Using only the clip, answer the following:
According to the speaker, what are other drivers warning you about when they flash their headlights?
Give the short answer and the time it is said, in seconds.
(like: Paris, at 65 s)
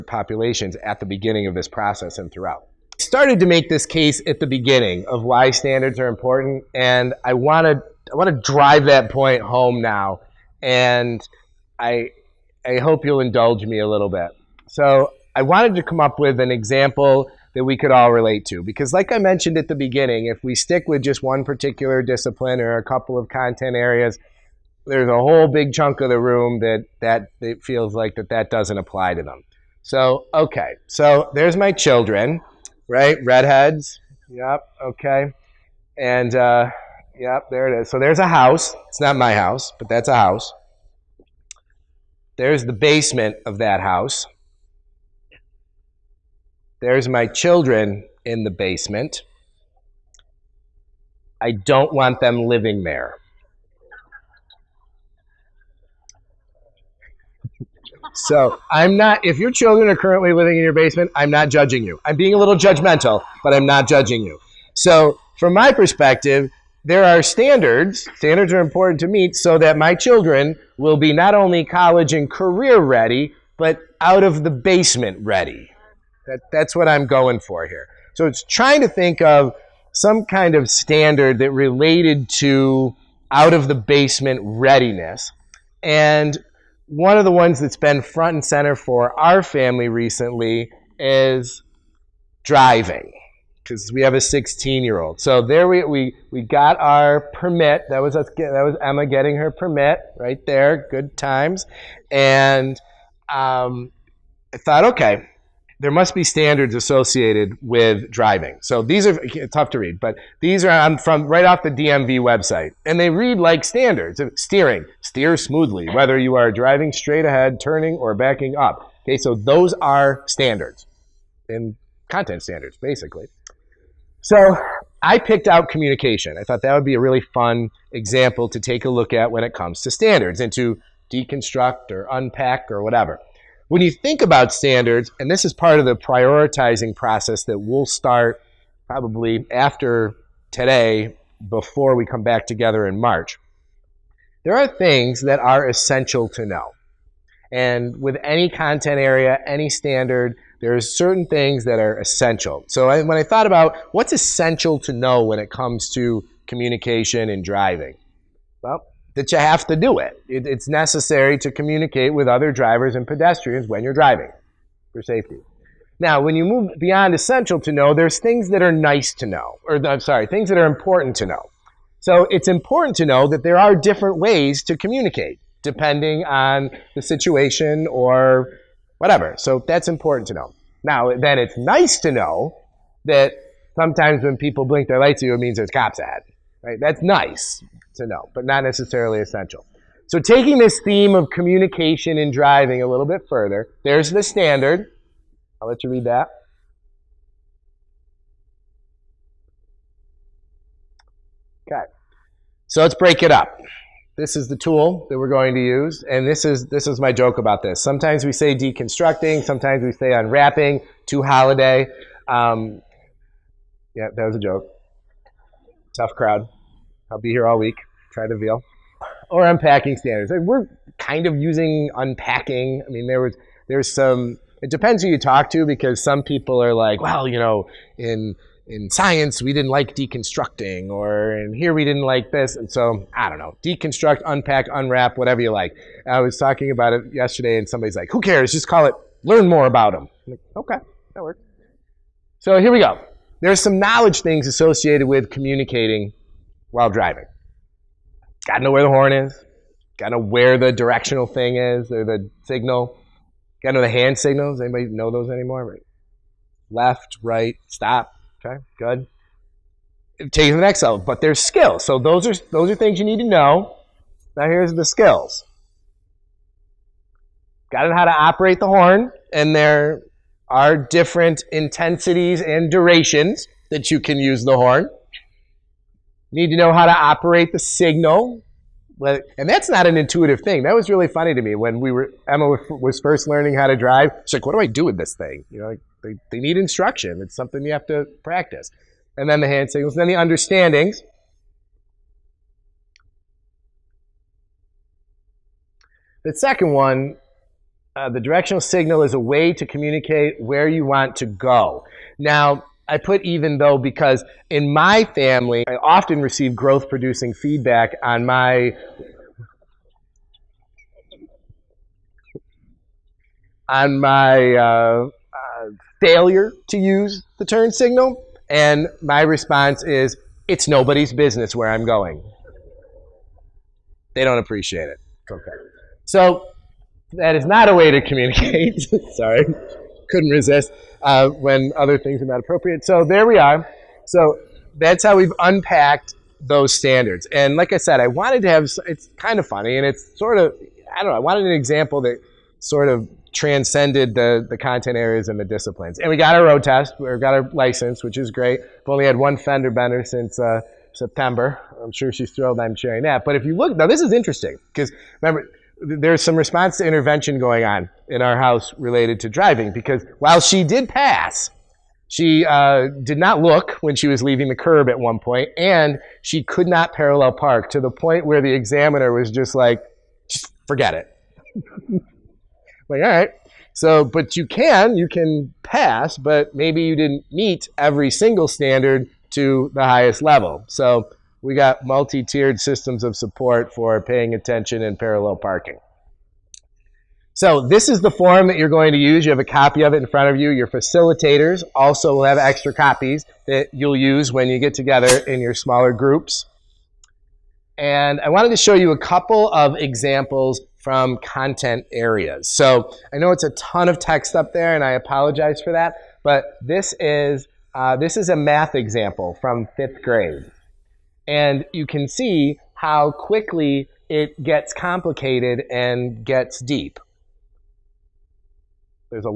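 cops, at 185 s.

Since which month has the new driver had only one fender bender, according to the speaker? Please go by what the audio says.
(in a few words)
September.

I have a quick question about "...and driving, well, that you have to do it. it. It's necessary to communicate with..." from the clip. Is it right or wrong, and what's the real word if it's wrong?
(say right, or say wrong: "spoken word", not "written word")
right.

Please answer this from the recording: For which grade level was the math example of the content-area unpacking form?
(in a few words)
5th grade.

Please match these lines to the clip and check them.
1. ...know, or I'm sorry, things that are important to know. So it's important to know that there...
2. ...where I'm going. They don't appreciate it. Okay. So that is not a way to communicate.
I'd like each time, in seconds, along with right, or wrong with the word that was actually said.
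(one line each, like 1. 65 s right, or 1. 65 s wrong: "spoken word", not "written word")
1. 169 s right
2. 321 s right.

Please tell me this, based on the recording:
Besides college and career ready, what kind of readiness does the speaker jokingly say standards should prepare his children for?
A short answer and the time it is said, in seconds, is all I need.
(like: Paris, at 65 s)
out of the basement ready, at 74 s.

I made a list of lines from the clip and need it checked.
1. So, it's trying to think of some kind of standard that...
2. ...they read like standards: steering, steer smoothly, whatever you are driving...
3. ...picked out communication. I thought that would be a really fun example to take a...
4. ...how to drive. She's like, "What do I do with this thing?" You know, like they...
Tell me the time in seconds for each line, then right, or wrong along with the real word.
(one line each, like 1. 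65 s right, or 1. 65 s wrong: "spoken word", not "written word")
1. 78 s right
2. 112 s wrong: "whether", not "whatever"
3. 125 s right
4. 283 s right.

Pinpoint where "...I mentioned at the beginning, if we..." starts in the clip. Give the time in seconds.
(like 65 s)
19 s.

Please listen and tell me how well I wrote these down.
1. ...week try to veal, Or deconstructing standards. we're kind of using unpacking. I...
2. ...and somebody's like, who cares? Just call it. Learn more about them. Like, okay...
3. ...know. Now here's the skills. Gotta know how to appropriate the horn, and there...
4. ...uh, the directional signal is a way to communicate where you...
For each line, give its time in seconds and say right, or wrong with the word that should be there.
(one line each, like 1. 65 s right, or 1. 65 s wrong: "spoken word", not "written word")
1. 217 s wrong: "unpacking", not "deconstructing"
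2. 237 s right
3. 263 s wrong: "operate", not "appropriate"
4. 297 s right.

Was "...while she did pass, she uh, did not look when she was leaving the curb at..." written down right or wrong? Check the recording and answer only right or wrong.
right.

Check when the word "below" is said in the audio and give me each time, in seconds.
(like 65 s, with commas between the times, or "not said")
not said.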